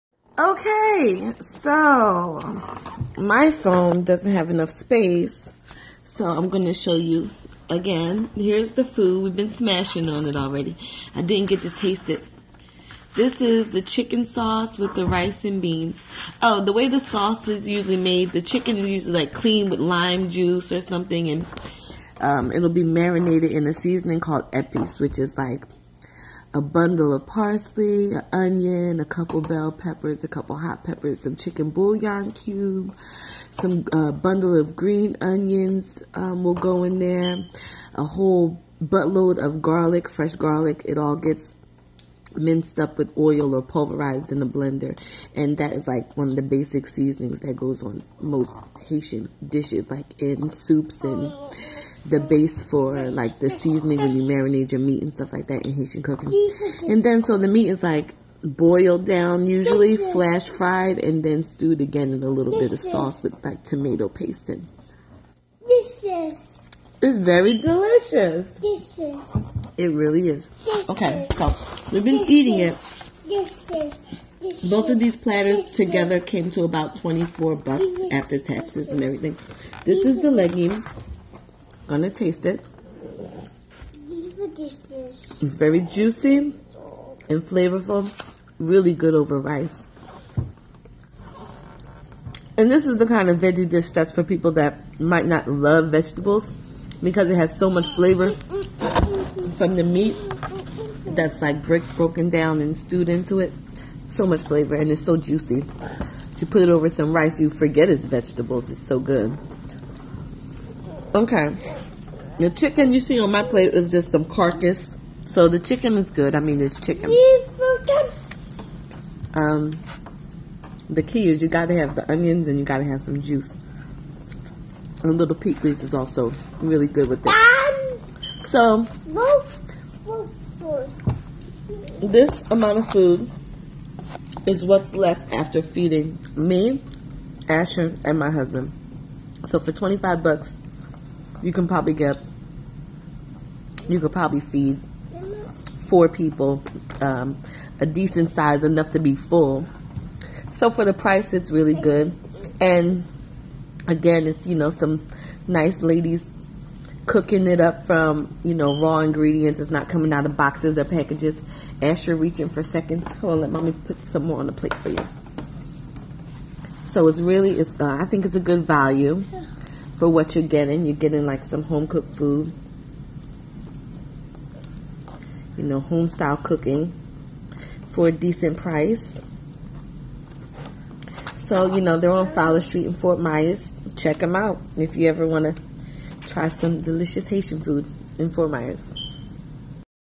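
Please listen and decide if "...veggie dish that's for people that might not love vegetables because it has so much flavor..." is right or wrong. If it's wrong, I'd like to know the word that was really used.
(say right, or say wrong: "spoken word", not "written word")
right.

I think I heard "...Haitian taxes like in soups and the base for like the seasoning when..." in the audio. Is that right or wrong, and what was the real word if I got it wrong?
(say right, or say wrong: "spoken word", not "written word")
wrong: "dishes", not "taxes".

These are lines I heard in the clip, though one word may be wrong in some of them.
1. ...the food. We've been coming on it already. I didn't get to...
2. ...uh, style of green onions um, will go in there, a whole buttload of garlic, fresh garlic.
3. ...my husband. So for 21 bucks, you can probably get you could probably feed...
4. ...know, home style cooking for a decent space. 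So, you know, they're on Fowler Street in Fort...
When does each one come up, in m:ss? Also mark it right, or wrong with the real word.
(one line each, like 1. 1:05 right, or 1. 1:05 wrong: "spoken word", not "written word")
1. 0:08 wrong: "smashing", not "coming"
2. 0:33 wrong: "bundle", not "style"
3. 2:18 wrong: "25", not "21"
4. 2:55 wrong: "price", not "space".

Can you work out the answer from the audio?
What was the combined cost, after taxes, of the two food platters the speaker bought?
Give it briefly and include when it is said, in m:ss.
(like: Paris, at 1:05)
$24, at 1:16.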